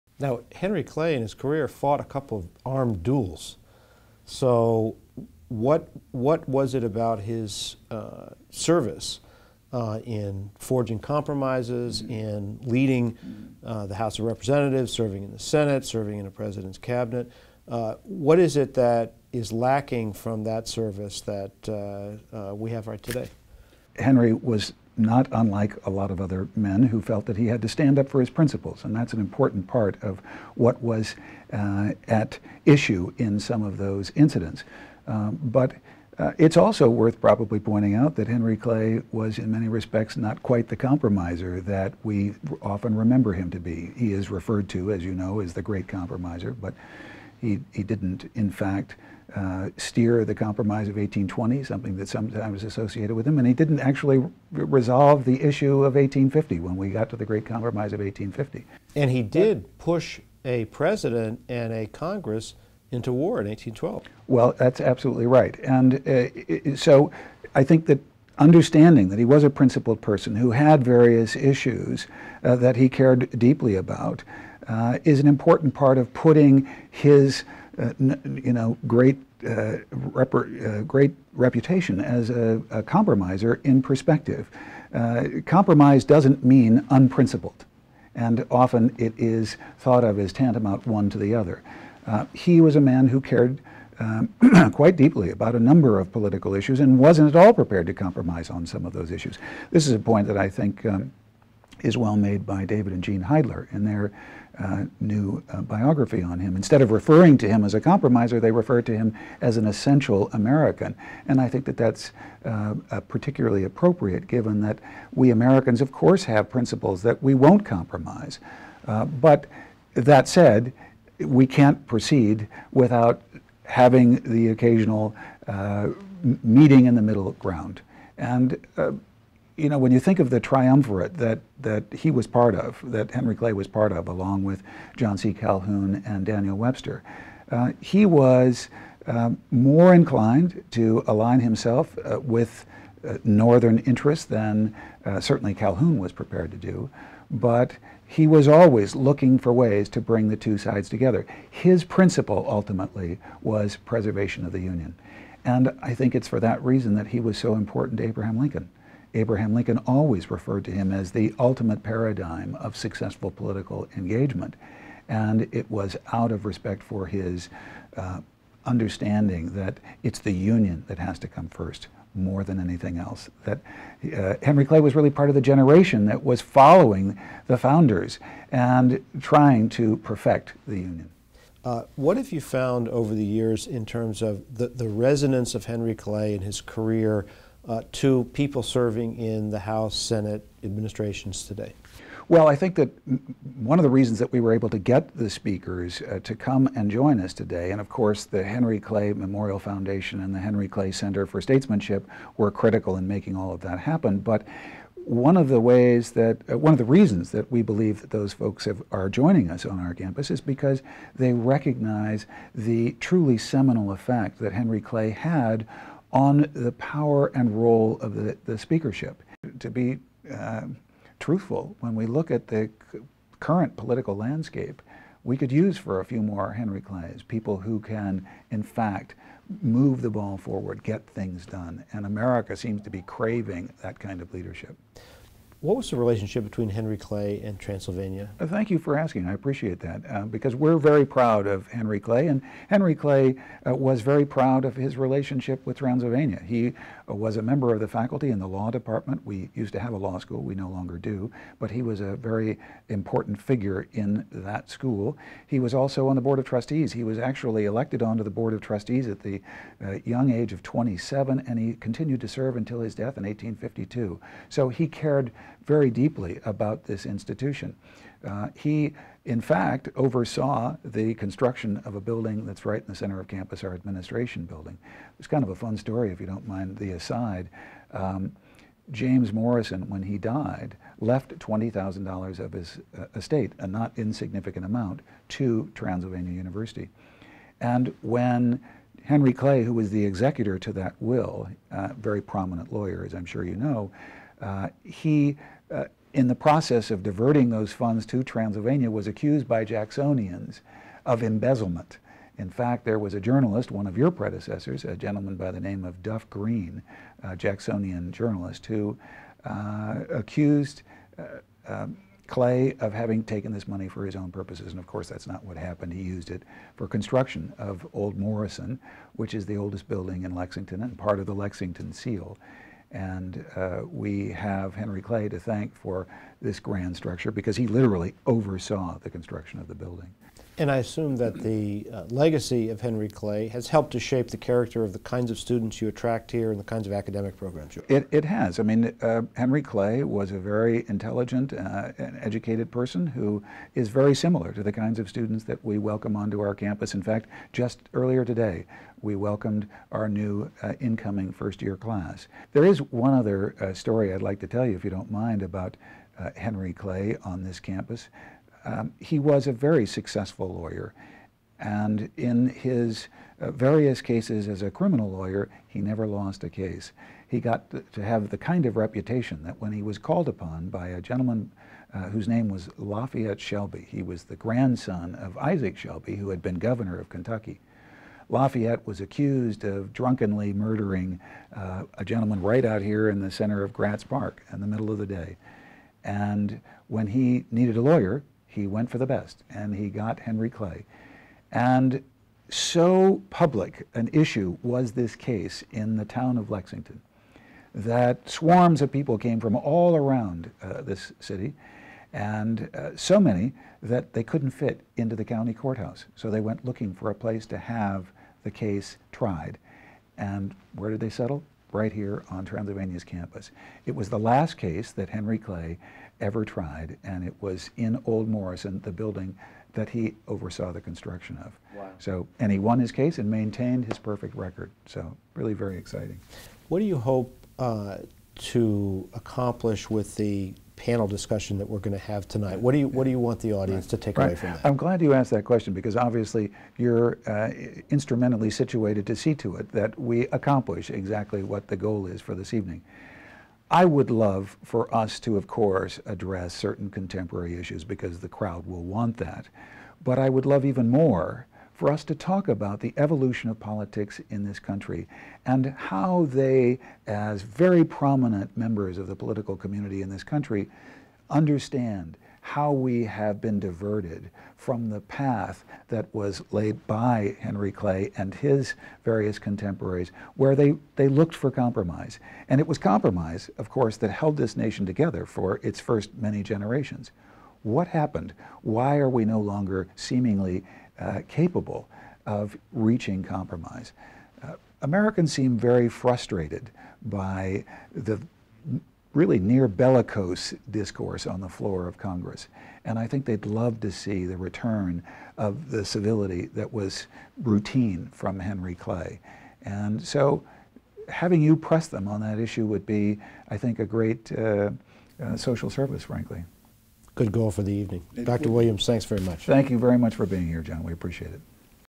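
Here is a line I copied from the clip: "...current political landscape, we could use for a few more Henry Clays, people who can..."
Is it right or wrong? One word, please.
right.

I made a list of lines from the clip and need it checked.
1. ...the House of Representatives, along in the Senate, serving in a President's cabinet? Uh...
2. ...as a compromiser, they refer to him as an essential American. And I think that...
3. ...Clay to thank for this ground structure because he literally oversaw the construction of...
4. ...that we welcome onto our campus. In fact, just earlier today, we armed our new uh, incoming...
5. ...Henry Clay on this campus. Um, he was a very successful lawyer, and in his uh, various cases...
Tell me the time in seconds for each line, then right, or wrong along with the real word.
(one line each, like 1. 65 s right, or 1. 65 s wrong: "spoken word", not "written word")
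1. 13 s wrong: "serving", not "along"
2. 107 s right
3. 325 s wrong: "grand", not "ground"
4. 345 s wrong: "welcomed", not "armed"
5. 356 s right.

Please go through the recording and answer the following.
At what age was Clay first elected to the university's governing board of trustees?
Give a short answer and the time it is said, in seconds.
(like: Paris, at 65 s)
27, at 260 s.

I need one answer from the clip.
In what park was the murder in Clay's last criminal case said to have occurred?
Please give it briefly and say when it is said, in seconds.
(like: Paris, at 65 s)
Gratz Park, at 383 s.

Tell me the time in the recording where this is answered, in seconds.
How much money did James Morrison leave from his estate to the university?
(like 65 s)
281 s.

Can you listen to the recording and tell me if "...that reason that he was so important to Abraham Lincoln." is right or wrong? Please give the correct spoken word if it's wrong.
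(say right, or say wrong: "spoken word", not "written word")
right.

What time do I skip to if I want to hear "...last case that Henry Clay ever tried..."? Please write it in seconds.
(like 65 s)
414 s.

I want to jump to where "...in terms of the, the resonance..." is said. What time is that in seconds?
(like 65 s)
183 s.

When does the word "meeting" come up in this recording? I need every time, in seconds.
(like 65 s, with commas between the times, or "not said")
126 s.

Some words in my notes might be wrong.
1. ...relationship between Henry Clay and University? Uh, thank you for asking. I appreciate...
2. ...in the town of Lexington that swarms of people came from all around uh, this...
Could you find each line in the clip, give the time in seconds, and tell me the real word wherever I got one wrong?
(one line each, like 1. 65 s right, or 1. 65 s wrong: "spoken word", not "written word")
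1. 235 s wrong: "Transylvania", not "University"
2. 395 s right.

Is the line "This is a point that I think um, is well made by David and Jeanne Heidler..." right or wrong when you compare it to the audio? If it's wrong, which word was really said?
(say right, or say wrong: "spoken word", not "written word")
right.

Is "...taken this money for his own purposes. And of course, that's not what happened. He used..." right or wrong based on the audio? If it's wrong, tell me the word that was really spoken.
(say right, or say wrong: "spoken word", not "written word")
right.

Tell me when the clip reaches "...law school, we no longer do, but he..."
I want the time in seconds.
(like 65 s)
249 s.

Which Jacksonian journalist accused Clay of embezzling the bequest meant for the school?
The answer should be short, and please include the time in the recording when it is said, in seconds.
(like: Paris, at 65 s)
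Duff Green, at 306 s.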